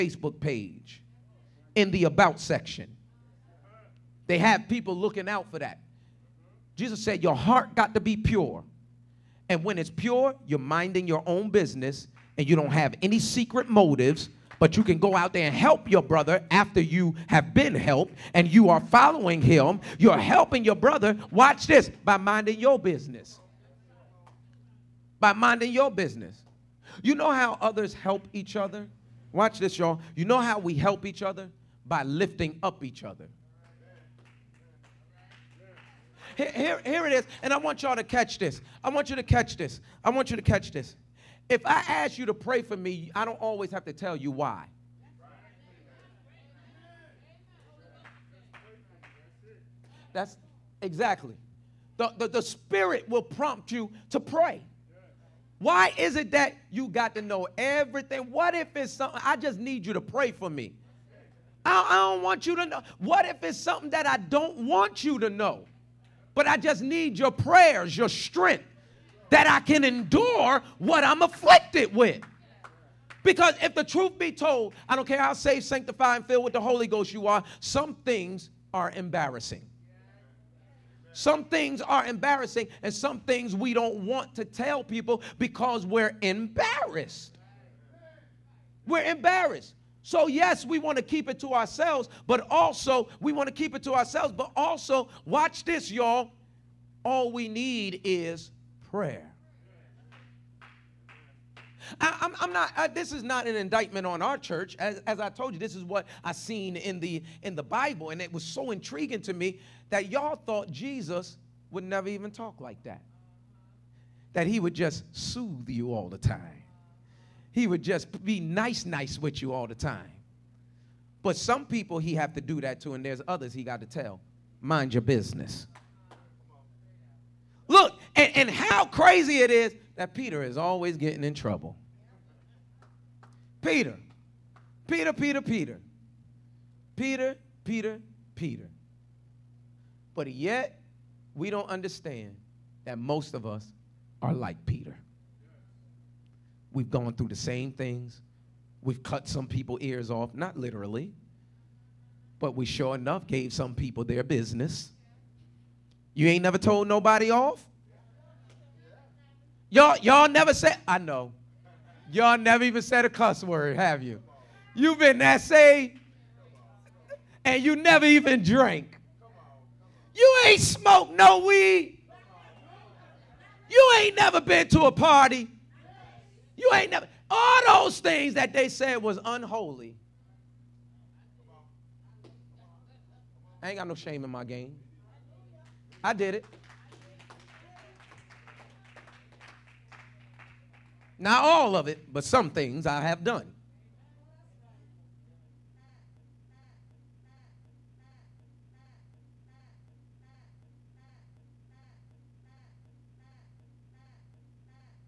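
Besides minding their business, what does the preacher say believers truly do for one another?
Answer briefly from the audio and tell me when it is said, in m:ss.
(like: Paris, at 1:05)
Lifting up each other, at 0:32.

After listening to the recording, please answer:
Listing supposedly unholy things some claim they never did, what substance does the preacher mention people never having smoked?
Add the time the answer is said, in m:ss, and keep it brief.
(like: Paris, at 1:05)
Weed, at 2:51.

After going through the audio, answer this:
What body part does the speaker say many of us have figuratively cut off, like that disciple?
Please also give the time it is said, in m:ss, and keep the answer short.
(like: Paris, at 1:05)
Ears, at 2:29.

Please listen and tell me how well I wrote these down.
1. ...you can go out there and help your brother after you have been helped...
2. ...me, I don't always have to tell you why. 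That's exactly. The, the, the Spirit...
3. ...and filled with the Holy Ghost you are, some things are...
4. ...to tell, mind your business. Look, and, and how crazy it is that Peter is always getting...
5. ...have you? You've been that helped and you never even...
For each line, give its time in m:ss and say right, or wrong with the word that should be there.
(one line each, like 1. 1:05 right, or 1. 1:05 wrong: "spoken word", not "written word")
1. 0:14 right
2. 0:42 right
3. 1:16 right
4. 2:03 right
5. 2:43 wrong: "saved", not "helped".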